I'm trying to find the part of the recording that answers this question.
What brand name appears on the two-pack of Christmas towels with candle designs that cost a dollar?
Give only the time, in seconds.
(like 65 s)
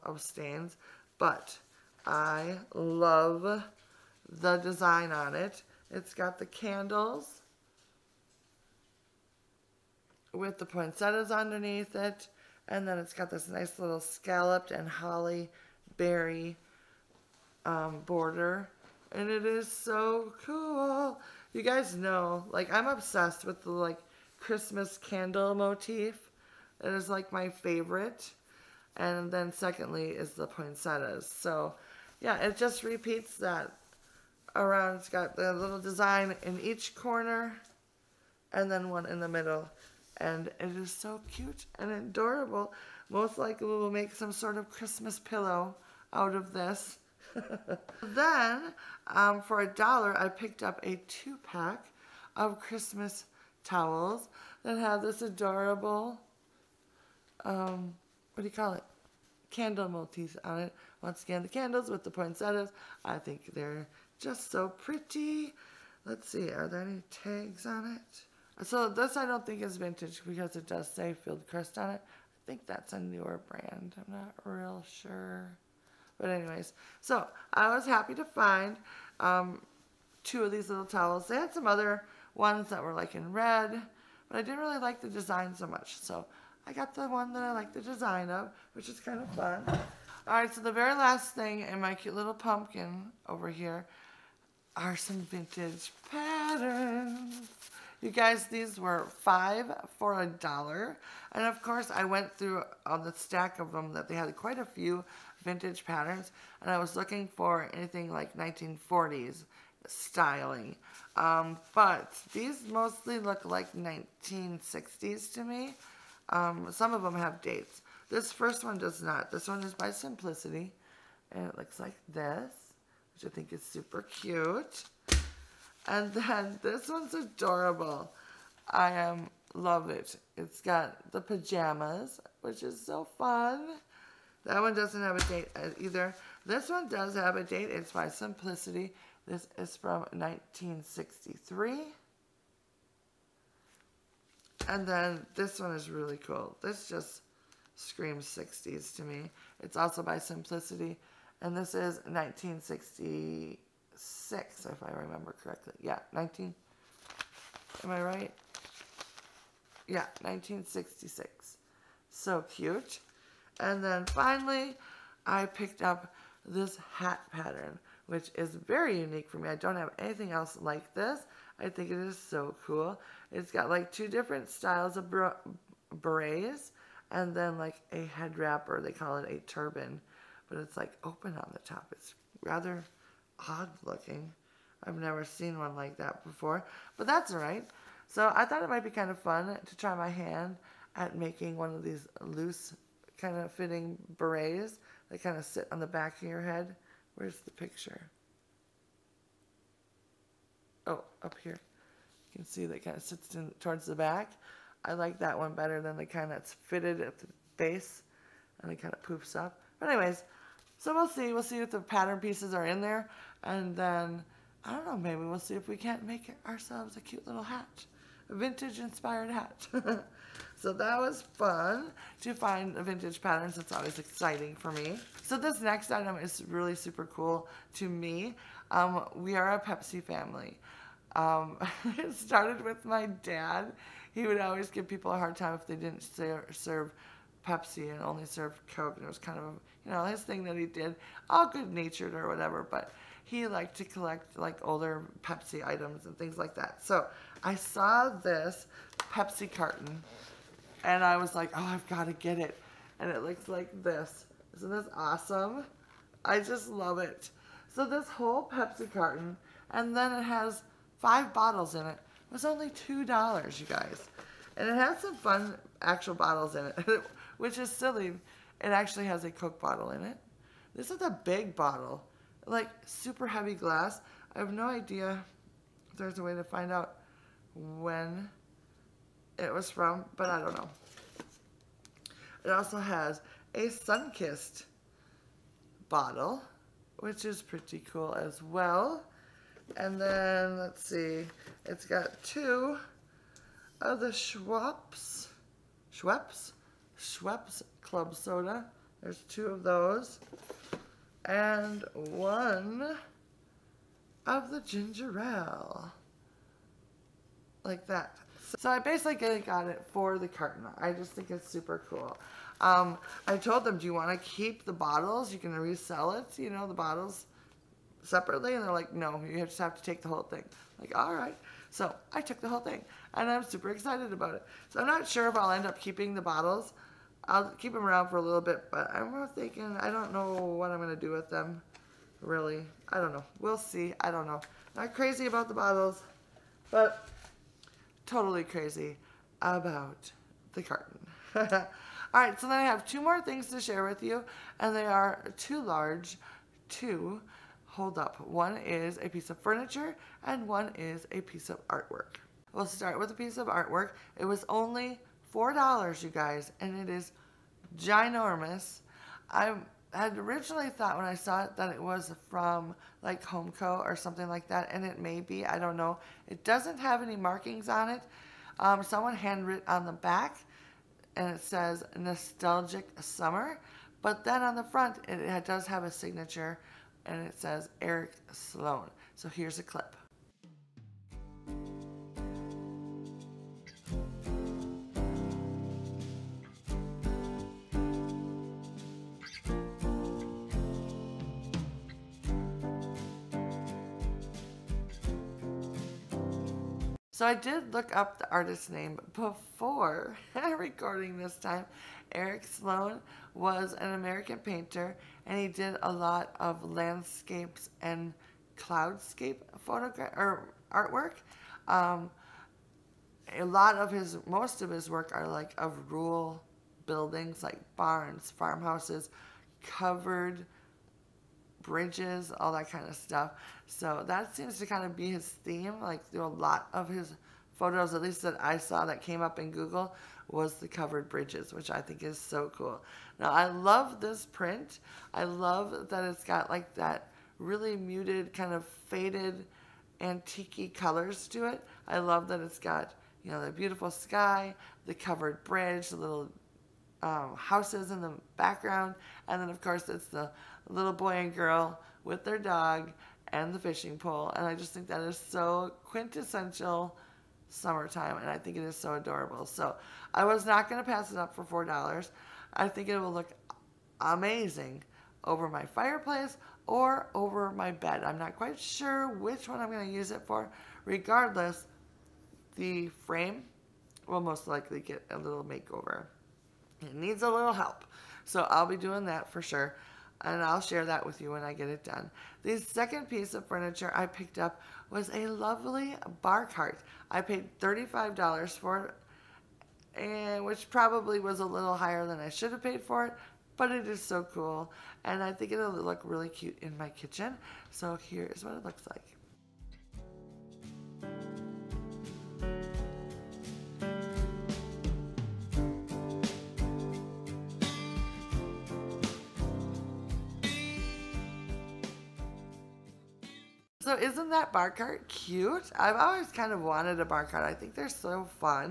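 71 s.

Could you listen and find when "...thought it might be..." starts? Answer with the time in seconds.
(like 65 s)
188 s.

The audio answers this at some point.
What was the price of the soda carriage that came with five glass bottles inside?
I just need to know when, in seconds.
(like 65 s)
262 s.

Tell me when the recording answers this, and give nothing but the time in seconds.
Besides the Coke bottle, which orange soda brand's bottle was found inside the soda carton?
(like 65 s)
283 s.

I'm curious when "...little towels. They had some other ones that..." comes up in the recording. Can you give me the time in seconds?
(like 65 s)
80 s.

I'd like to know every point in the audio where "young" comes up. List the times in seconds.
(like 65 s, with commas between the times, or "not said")
not said.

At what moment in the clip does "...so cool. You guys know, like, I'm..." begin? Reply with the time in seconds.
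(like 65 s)
19 s.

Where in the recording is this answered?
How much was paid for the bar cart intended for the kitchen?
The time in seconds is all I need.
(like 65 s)
487 s.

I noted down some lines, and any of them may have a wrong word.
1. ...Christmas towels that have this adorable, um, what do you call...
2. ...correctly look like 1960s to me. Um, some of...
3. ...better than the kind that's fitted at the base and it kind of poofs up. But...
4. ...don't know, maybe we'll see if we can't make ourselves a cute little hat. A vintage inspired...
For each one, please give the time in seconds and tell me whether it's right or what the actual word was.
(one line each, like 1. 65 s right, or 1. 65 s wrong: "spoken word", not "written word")
1. 52 s right
2. 112 s wrong: "mostly", not "correctly"
3. 205 s right
4. 214 s right.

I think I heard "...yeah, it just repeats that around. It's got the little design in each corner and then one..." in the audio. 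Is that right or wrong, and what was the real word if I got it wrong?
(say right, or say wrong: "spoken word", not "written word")
right.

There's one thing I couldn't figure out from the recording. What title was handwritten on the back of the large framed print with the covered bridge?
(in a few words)
Nostalgic Summer.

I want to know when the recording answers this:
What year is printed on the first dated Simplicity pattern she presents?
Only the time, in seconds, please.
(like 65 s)
140 s.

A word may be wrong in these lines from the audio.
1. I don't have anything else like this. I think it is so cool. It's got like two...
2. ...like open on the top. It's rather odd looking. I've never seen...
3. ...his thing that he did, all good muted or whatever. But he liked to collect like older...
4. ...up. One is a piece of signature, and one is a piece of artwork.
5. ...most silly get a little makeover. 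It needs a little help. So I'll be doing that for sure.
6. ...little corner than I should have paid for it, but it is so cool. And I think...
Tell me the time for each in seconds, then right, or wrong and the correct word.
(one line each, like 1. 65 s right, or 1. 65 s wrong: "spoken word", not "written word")
1. 169 s right
2. 180 s right
3. 240 s wrong: "natured", not "muted"
4. 347 s wrong: "furniture", not "signature"
5. 474 s wrong: "likely", not "silly"
6. 491 s wrong: "higher", not "corner".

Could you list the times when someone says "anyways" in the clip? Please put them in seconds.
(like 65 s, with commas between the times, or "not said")
76 s, 209 s.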